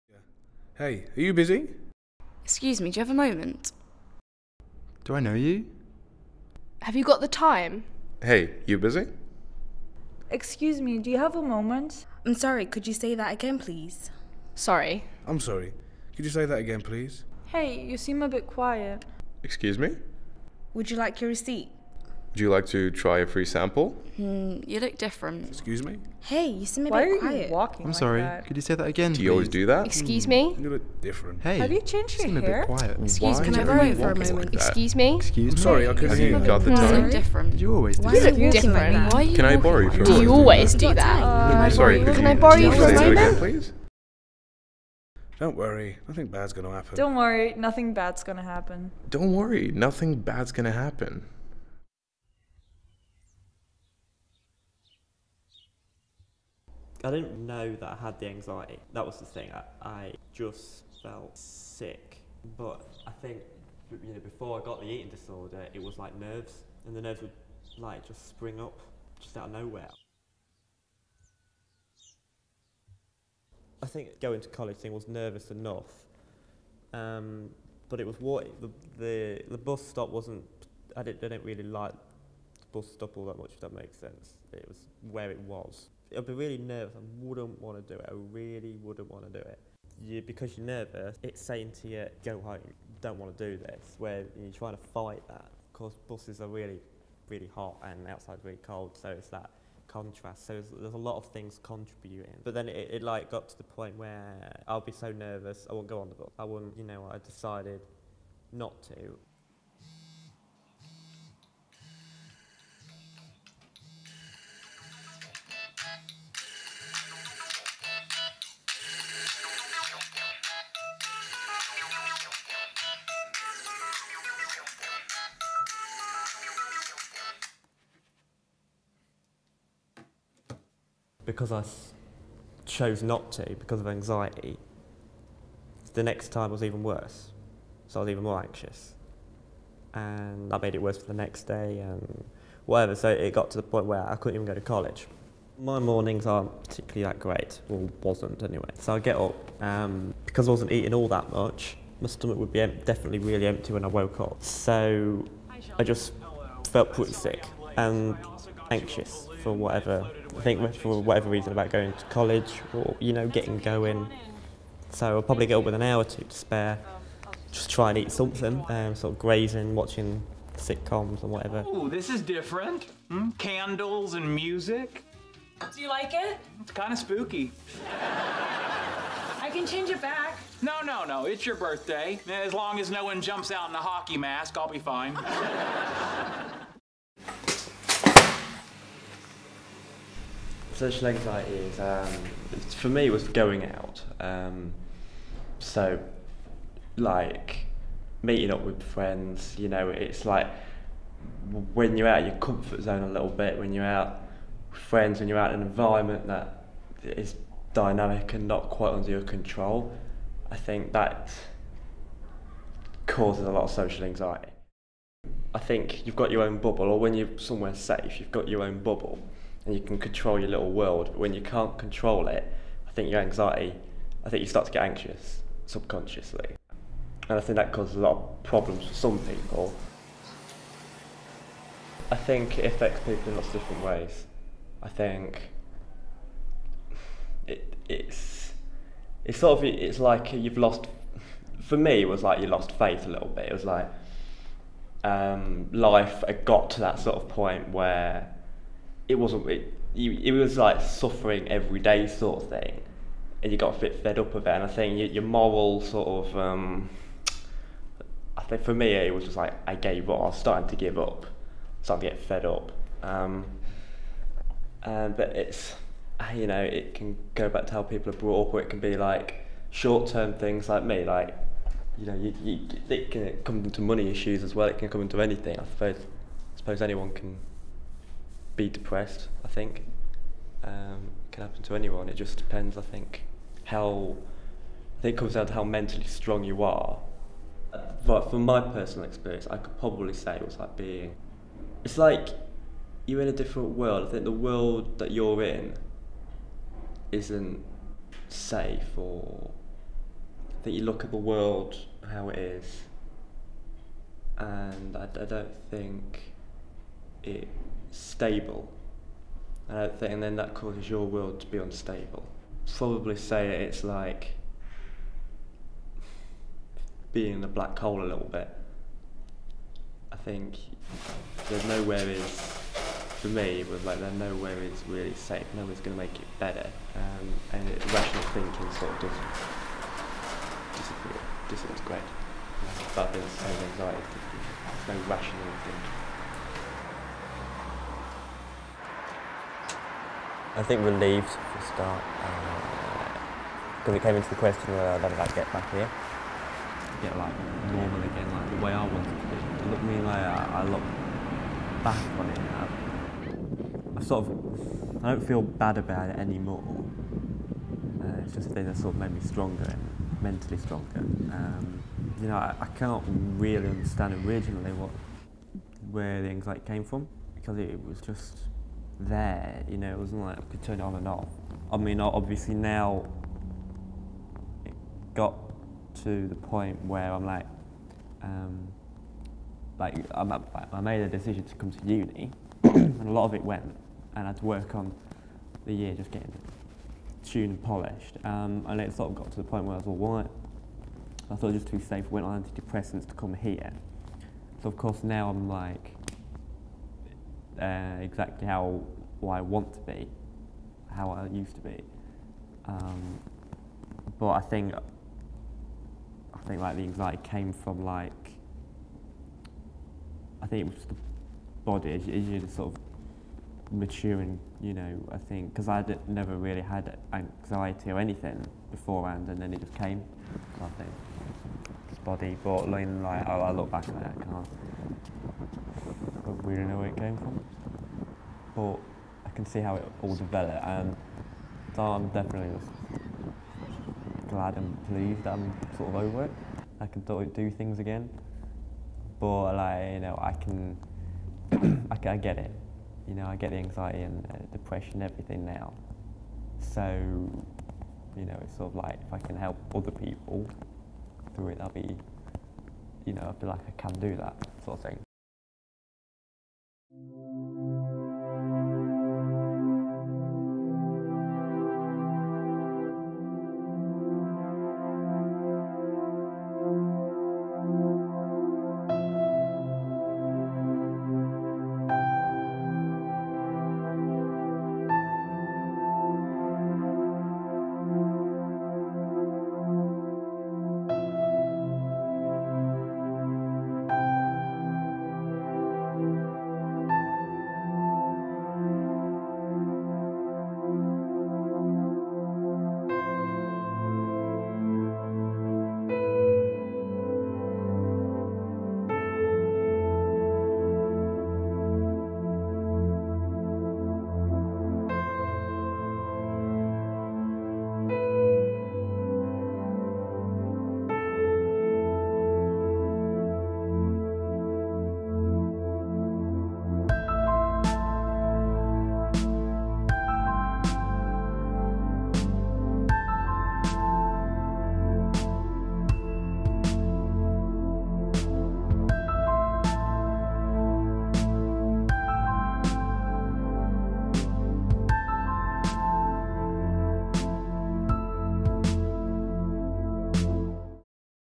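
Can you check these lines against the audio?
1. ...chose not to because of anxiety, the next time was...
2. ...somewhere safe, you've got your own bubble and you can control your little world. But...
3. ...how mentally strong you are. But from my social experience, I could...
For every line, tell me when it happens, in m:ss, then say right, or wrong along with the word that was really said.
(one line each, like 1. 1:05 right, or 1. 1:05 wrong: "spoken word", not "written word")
1. 2:12 right
2. 3:37 right
3. 4:45 wrong: "personal", not "social".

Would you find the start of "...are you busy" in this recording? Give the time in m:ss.
0:01.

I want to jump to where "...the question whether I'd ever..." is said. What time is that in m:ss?
5:44.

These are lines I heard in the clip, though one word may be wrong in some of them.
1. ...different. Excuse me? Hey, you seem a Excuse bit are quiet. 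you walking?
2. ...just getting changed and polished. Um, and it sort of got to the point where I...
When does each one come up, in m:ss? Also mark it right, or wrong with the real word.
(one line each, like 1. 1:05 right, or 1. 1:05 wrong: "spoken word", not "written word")
1. 0:24 wrong: "Why", not "Excuse"
2. 6:25 wrong: "tuned", not "changed".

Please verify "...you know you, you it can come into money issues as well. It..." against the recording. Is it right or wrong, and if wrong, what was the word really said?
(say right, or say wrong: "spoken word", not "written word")
right.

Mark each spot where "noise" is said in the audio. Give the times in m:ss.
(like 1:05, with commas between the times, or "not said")
not said.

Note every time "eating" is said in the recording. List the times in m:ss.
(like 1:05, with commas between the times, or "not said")
1:04, 2:30.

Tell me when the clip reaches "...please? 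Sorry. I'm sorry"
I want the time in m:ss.
0:13.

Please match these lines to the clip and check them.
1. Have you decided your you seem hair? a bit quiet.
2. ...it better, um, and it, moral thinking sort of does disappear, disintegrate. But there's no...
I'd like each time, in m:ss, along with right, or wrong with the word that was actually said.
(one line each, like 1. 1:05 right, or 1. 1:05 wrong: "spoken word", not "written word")
1. 0:31 wrong: "changed", not "decided"
2. 5:26 wrong: "rational", not "moral".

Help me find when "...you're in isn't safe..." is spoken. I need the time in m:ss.
4:55.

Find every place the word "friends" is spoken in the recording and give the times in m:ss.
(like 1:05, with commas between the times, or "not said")
3:18, 3:24.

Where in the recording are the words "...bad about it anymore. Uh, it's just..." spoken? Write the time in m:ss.
5:55.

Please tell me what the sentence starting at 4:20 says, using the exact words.
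I was starting to give up, starting to get fed up.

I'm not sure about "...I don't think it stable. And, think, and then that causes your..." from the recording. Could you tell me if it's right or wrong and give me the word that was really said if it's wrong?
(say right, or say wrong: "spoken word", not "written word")
right.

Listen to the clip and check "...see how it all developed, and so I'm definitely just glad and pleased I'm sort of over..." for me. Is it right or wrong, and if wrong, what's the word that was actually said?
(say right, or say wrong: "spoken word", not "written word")
right.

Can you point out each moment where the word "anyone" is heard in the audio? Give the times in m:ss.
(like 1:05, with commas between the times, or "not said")
4:36, 4:41.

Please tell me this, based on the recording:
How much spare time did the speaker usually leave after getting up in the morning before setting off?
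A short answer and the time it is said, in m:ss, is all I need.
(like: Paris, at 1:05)
an hour or two, at 2:45.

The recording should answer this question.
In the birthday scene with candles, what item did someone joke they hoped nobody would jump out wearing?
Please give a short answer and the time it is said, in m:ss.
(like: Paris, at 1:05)
a hockey mask, at 3:03.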